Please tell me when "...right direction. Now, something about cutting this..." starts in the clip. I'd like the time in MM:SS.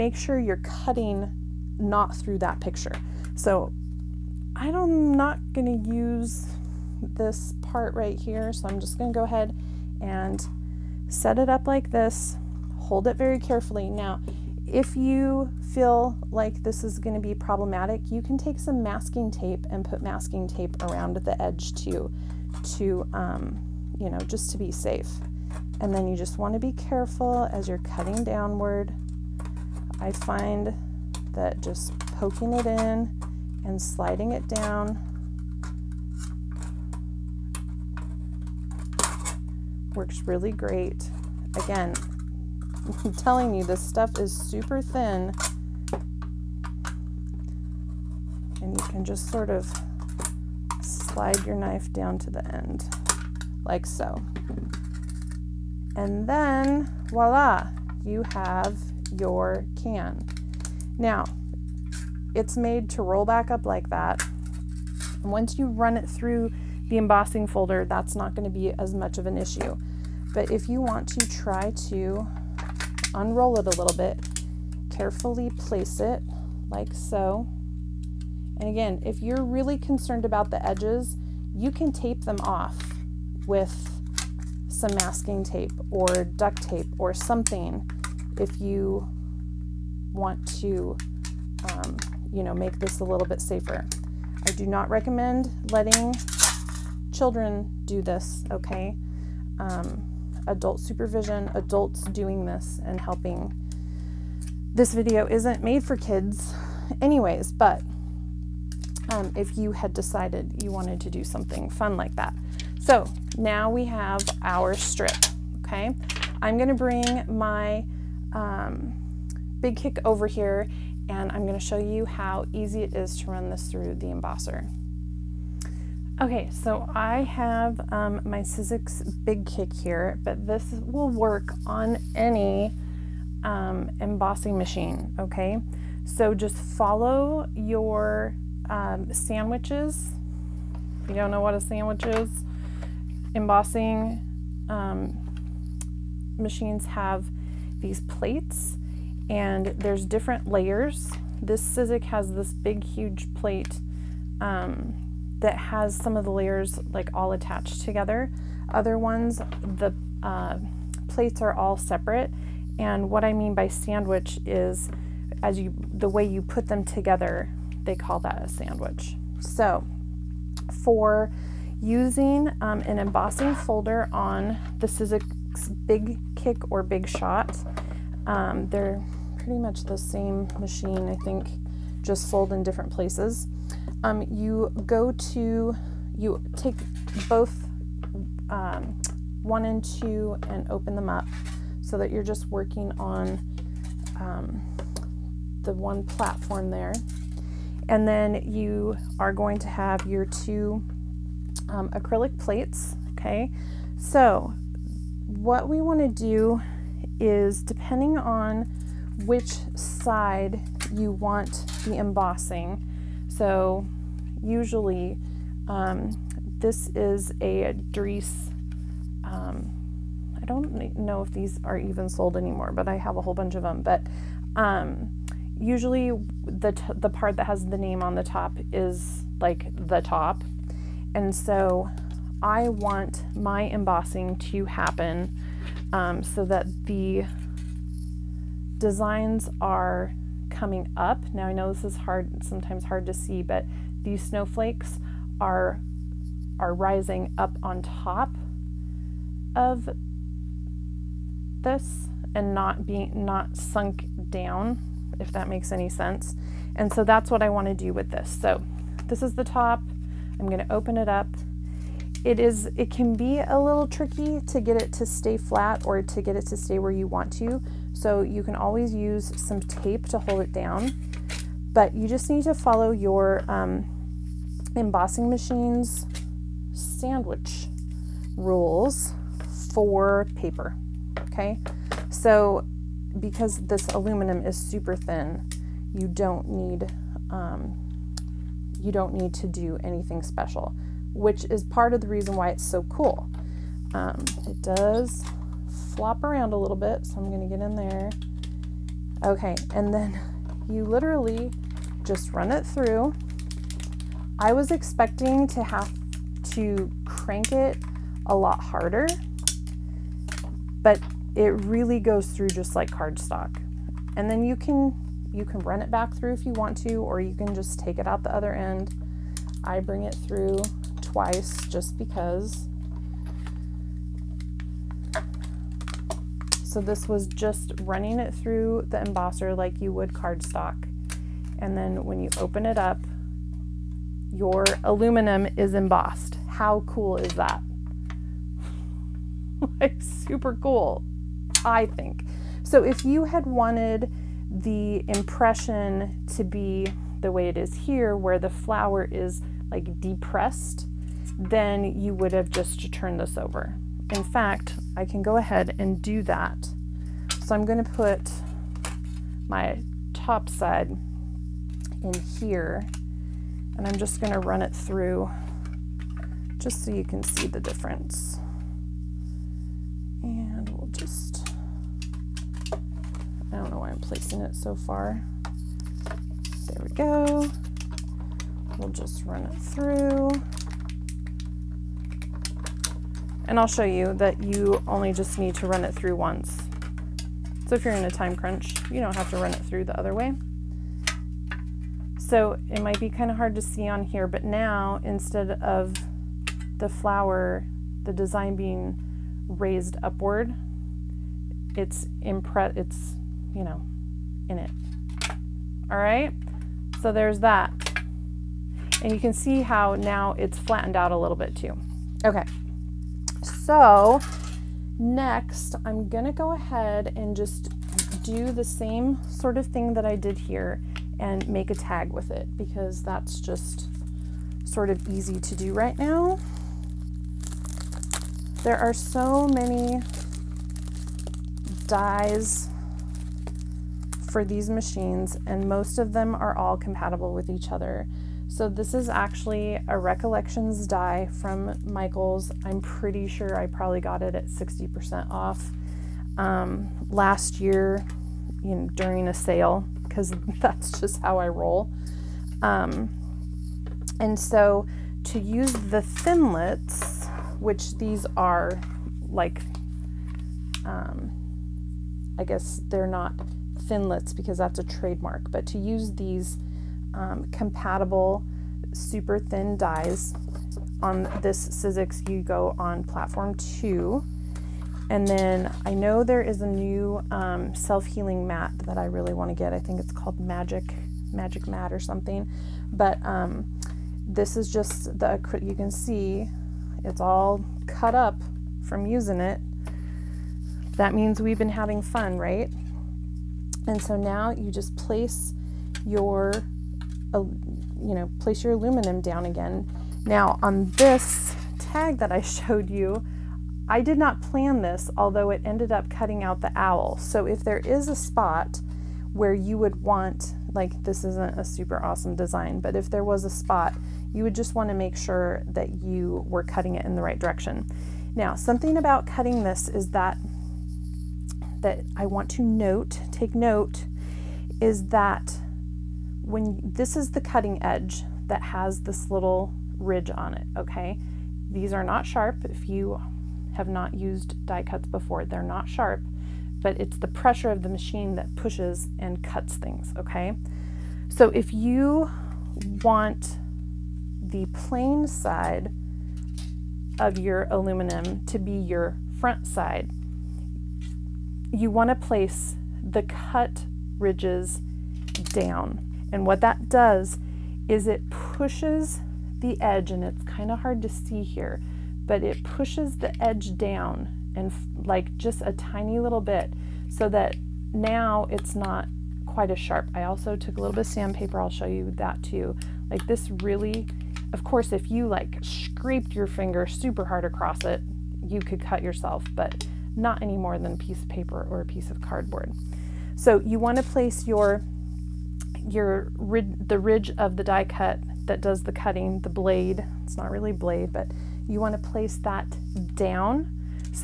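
08:37.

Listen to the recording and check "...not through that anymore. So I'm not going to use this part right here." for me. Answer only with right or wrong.
wrong.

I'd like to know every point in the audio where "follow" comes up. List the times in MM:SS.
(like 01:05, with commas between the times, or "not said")
02:16, 04:32.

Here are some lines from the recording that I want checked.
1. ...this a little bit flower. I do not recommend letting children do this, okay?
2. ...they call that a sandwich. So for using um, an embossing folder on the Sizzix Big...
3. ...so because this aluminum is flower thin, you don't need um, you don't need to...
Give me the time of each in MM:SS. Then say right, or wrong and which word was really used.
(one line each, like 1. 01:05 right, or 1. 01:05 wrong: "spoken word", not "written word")
1. 01:32 wrong: "safer", not "flower"
2. 02:47 right
3. 04:42 wrong: "super", not "flower".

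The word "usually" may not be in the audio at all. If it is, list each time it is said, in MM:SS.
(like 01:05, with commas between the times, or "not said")
03:34, 03:45.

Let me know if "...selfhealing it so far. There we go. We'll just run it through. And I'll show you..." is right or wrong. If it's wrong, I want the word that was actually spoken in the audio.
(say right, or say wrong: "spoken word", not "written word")
wrong: "placing", not "selfhealing".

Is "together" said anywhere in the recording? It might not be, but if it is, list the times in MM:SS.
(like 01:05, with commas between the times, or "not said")
02:37, 02:46.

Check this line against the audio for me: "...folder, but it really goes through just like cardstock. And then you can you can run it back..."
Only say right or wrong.
wrong.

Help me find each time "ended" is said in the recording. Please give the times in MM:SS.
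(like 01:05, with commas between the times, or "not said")
08:25.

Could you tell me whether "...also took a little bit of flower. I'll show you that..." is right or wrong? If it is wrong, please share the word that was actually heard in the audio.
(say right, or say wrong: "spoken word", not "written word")
wrong: "sandpaper", not "flower".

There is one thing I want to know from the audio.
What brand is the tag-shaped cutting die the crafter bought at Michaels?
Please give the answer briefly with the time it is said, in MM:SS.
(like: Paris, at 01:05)
Recollections, at 07:19.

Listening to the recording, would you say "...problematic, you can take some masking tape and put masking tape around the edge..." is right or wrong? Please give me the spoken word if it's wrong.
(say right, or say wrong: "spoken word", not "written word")
right.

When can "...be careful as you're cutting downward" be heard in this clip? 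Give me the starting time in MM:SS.
00:26.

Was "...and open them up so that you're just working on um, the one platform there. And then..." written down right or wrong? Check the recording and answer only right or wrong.
right.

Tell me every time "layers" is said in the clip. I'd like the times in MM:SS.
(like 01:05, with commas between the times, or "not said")
02:30, 02:36.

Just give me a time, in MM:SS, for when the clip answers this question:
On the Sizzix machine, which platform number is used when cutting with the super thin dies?
07:53.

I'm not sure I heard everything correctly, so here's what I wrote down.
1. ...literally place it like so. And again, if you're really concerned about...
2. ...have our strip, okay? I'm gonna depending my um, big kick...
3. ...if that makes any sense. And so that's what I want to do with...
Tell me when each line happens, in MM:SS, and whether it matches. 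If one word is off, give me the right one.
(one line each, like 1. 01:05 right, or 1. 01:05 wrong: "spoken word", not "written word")
1. 01:14 wrong: "carefully", not "literally"
2. 01:53 wrong: "bring", not "depending"
3. 04:15 right.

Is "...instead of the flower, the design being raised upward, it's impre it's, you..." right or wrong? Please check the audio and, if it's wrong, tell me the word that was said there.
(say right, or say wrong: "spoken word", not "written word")
right.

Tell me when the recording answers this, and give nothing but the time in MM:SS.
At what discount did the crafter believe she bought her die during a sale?
07:24.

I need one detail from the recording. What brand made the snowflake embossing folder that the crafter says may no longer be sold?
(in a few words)
Darice.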